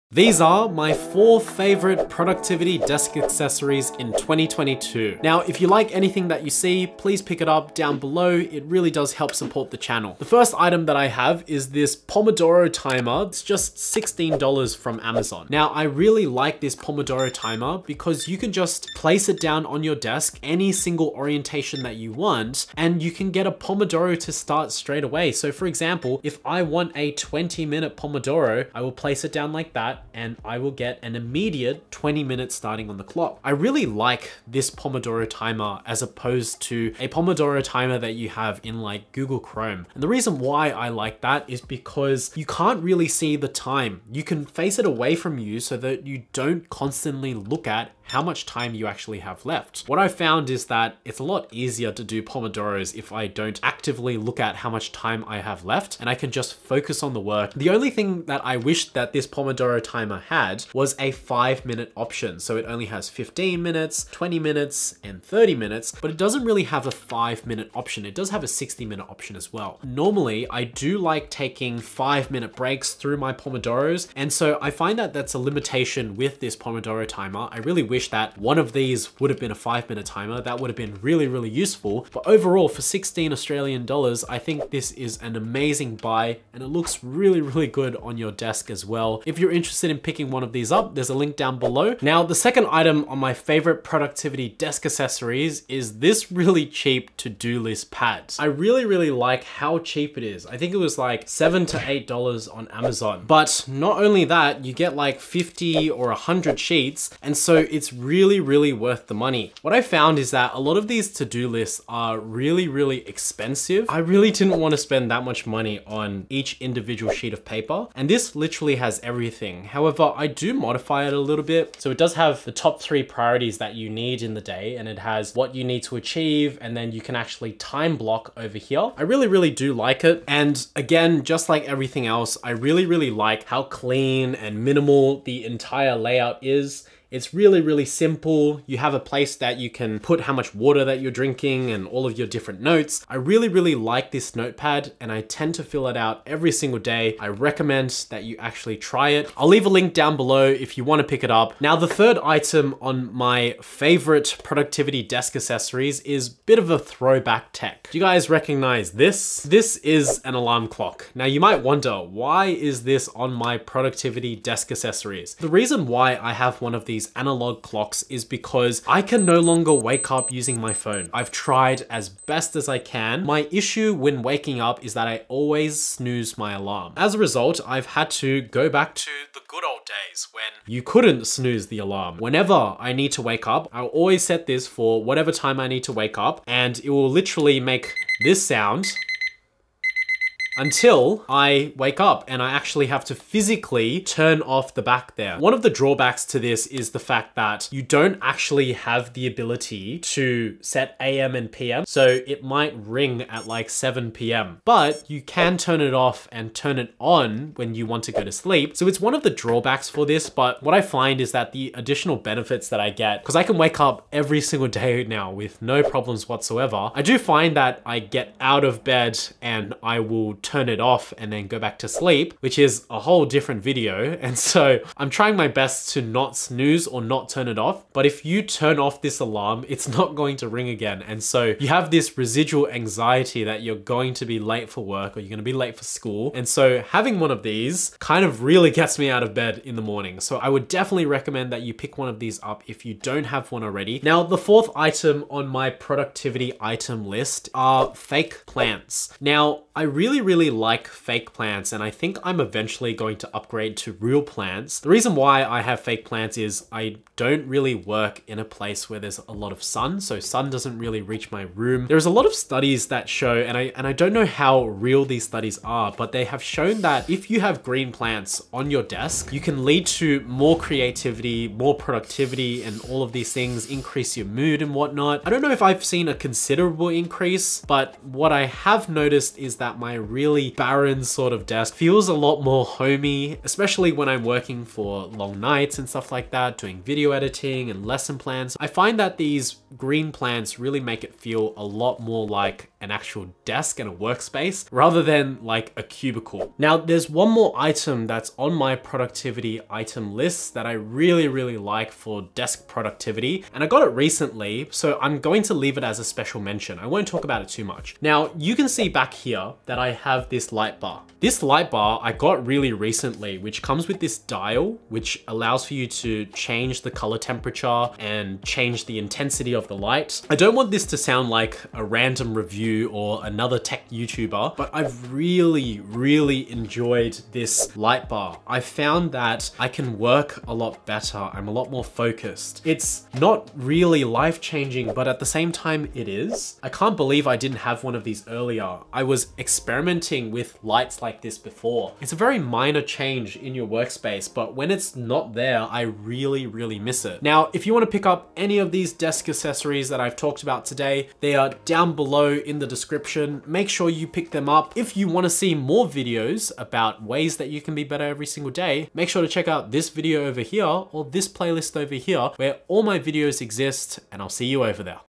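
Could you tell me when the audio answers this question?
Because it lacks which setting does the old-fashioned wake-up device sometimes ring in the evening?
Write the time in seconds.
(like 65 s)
200 s.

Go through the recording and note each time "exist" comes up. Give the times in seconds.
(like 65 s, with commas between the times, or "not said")
363 s.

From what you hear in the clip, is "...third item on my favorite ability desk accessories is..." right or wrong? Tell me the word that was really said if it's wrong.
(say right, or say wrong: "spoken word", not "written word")
wrong: "productivity", not "ability".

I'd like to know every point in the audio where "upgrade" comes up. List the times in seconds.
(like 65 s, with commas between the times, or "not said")
253 s.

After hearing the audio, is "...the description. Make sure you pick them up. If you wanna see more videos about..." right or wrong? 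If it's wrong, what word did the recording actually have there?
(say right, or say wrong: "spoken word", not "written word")
right.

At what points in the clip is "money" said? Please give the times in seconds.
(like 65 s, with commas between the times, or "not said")
109 s, 115 s.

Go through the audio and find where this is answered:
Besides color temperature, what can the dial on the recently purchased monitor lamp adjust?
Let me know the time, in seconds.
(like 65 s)
318 s.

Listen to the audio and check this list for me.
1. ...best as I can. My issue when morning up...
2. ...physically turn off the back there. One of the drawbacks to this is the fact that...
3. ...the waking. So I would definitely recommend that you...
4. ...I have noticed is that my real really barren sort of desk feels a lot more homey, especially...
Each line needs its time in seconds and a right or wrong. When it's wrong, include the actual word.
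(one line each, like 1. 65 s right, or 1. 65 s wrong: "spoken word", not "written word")
1. 172 s wrong: "waking", not "morning"
2. 193 s right
3. 239 s wrong: "morning", not "waking"
4. 278 s right.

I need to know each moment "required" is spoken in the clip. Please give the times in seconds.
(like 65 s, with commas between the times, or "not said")
not said.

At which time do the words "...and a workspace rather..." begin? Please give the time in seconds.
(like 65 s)
293 s.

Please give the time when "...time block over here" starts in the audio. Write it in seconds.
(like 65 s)
127 s.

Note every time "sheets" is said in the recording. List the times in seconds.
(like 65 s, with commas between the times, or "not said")
106 s, 117 s.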